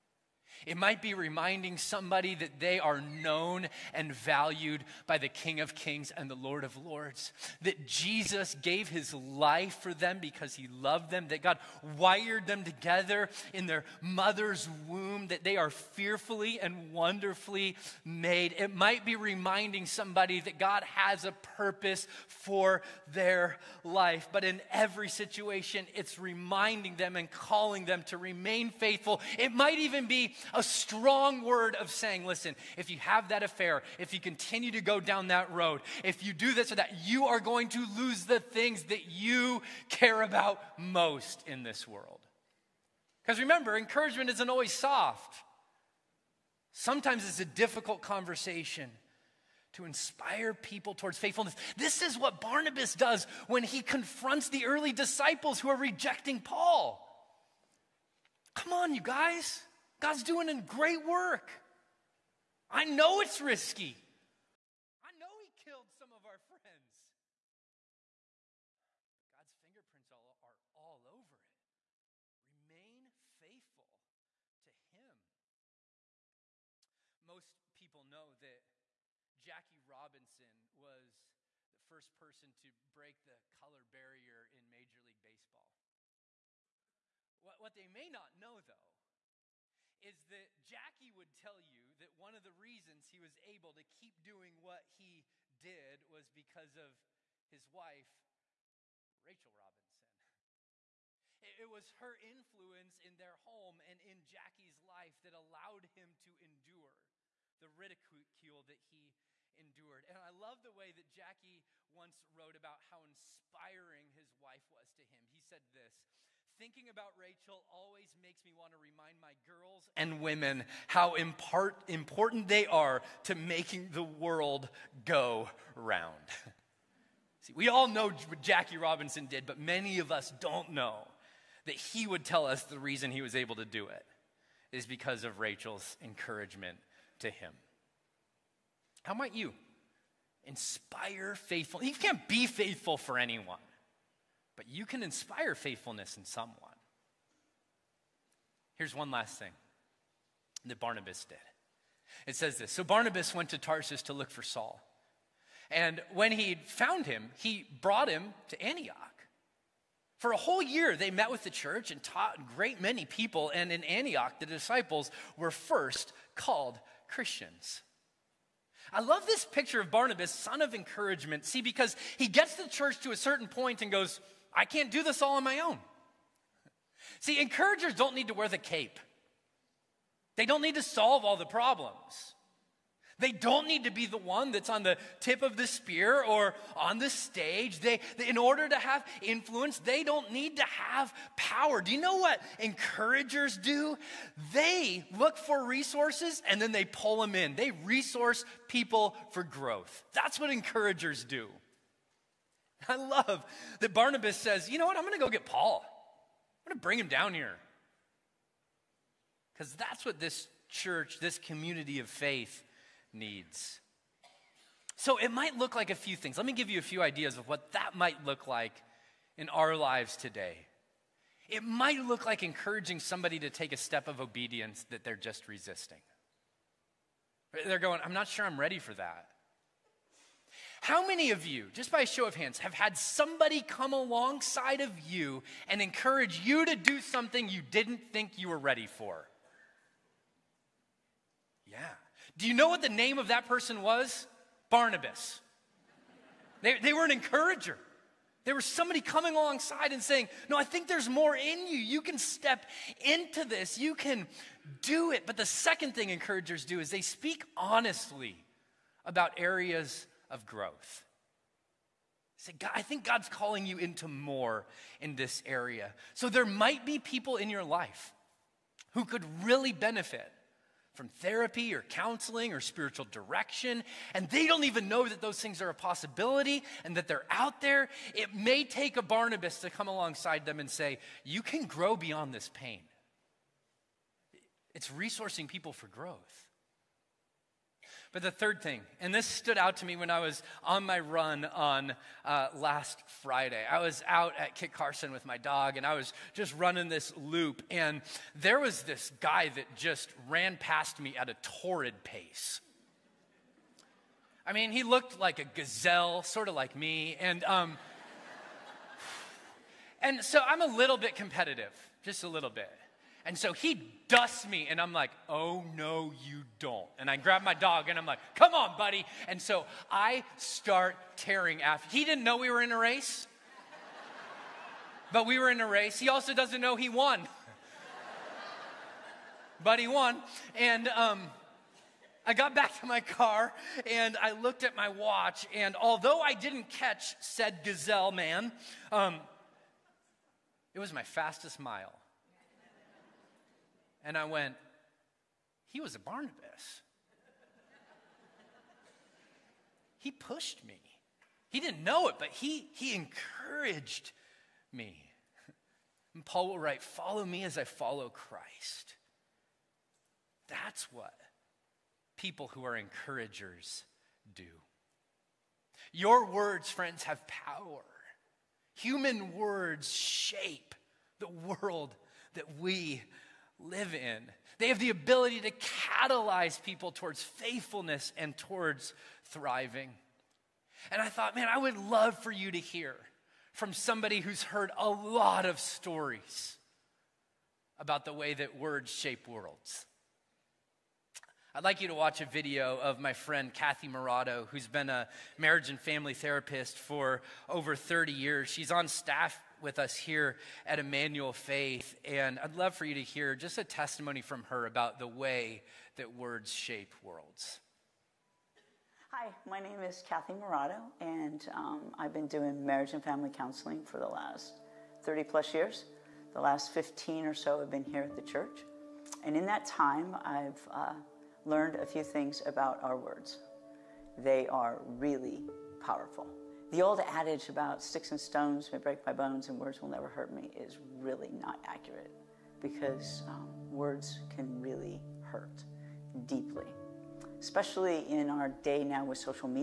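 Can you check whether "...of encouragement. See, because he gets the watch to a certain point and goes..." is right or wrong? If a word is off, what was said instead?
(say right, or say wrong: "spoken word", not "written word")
wrong: "church", not "watch".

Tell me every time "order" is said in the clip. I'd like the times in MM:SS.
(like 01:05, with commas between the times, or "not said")
03:08.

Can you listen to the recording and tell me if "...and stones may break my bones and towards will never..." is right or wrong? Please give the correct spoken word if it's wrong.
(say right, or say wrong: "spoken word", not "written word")
wrong: "words", not "towards".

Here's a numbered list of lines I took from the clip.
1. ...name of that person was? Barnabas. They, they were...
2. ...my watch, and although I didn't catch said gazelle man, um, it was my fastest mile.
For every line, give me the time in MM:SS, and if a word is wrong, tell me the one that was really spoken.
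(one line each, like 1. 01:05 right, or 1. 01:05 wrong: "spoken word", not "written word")
1. 04:02 right
2. 05:34 right.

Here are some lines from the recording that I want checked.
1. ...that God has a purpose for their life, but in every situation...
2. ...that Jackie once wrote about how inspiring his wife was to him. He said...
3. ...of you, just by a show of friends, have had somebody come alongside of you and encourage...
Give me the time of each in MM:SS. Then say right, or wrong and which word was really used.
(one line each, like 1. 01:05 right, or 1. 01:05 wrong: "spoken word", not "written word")
1. 00:20 right
2. 01:50 right
3. 03:51 wrong: "hands", not "friends".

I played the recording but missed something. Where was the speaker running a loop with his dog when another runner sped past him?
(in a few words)
Kit Carson.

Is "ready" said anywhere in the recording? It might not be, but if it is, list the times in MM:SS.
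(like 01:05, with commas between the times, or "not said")
03:48, 03:58.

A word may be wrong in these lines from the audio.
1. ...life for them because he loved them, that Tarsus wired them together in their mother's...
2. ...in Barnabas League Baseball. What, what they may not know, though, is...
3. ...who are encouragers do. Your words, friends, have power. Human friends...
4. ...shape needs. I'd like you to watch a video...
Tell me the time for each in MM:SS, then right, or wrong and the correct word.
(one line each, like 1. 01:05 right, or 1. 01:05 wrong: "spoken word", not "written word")
1. 00:09 wrong: "God", not "Tarsus"
2. 01:24 wrong: "Major", not "Barnabas"
3. 06:02 wrong: "words", not "friends"
4. 06:28 wrong: "worlds", not "needs".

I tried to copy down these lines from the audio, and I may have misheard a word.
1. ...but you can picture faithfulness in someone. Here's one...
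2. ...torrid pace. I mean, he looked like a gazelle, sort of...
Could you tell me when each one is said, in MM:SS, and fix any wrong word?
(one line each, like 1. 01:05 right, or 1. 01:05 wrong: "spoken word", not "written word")
1. 02:24 wrong: "inspire", not "picture"
2. 05:01 right.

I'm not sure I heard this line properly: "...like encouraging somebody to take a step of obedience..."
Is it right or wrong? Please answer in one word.
right.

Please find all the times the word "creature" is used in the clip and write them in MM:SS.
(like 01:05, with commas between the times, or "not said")
not said.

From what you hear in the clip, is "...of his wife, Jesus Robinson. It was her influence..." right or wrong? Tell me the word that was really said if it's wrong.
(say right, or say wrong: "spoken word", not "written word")
wrong: "Rachel", not "Jesus".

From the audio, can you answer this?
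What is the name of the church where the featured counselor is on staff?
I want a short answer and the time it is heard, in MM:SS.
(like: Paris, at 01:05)
Emmanuel Faith, at 06:40.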